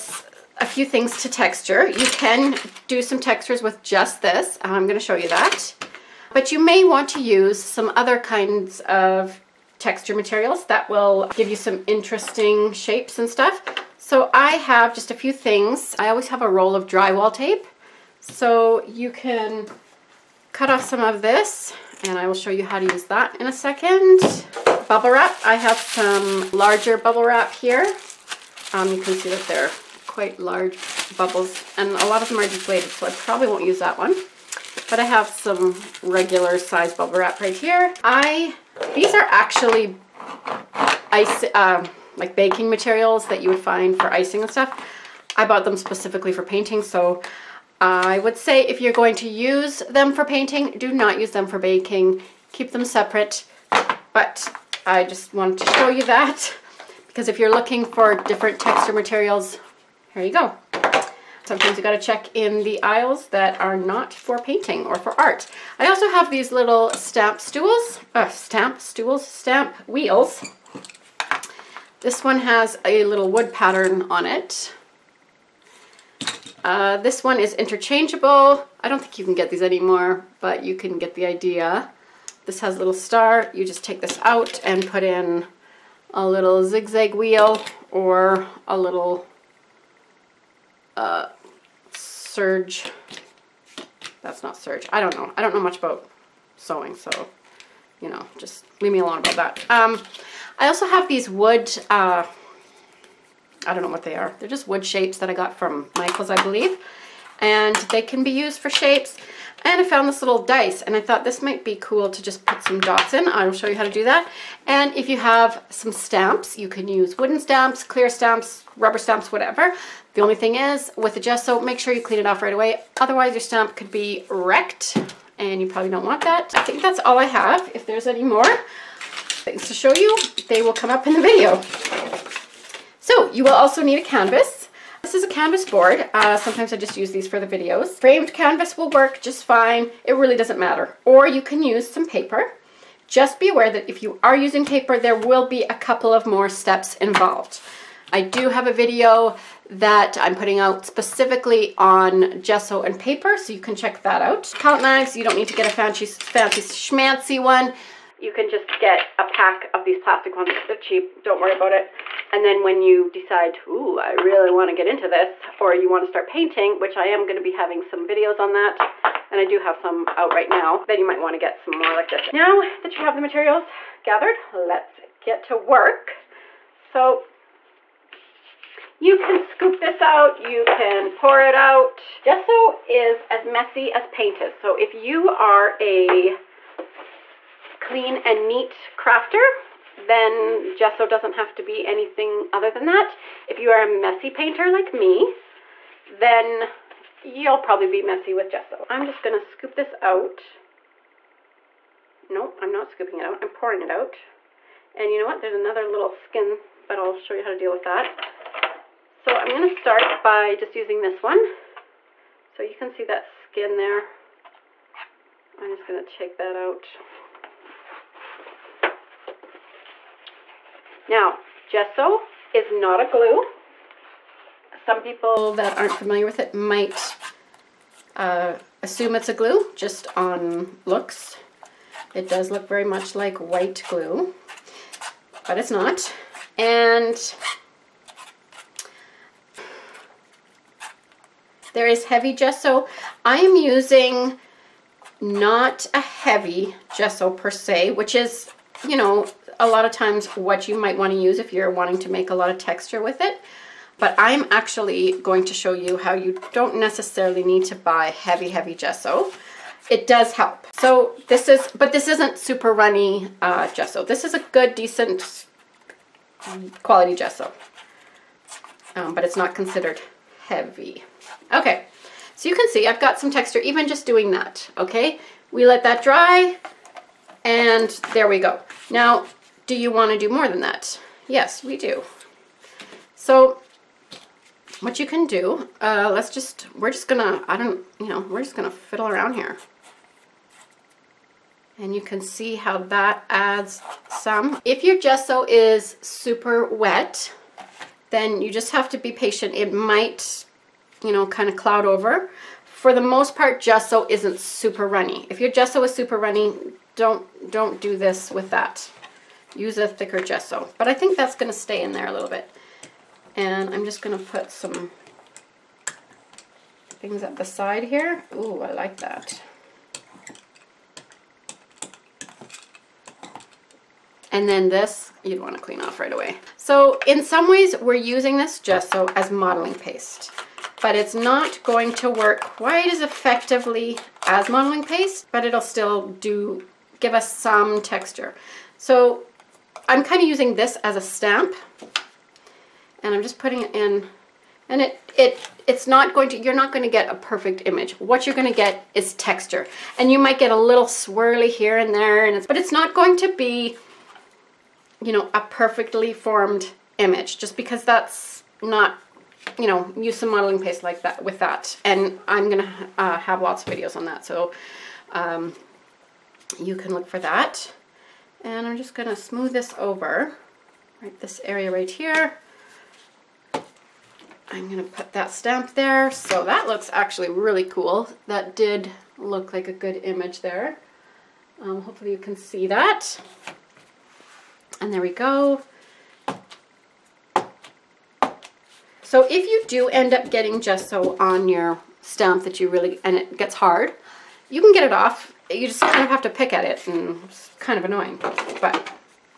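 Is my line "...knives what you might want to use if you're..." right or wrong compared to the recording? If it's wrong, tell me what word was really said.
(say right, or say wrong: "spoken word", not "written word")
wrong: "times", not "knives".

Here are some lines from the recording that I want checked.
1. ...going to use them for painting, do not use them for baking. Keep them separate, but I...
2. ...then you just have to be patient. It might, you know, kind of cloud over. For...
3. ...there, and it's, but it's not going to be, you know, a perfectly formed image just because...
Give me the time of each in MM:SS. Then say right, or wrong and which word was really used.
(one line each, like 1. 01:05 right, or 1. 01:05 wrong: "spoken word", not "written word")
1. 00:48 right
2. 04:58 right
3. 05:51 right.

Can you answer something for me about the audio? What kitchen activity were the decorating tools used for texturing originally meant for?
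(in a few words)
Icing.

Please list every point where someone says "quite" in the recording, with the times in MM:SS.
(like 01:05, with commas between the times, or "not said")
00:30, 05:32.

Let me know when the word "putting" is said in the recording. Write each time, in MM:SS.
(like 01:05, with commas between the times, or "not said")
02:30, 05:43.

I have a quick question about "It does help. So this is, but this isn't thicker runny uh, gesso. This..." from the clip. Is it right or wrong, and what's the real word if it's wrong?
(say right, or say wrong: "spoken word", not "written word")
wrong: "super", not "thicker".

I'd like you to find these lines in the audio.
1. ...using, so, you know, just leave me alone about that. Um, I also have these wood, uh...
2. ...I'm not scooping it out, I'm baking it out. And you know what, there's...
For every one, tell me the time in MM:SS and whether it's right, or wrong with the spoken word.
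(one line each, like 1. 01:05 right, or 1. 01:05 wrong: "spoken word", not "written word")
1. 01:36 wrong: "sewing", not "using"
2. 03:22 wrong: "pouring", not "baking".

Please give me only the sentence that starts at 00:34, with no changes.
But I have some regular size bubble wrap right here.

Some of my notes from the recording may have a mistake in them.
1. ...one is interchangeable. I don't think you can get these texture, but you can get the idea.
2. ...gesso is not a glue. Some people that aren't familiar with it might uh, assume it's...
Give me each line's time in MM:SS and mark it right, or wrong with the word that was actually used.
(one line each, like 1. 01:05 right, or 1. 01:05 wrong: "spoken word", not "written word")
1. 01:17 wrong: "anymore", not "texture"
2. 03:41 right.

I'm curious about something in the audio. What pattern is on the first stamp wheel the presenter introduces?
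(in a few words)
Wood pattern.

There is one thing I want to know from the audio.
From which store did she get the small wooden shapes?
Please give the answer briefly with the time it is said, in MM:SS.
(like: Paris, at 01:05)
Michael's, at 01:45.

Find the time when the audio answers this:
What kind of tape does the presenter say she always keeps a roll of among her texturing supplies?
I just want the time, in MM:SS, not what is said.
00:16.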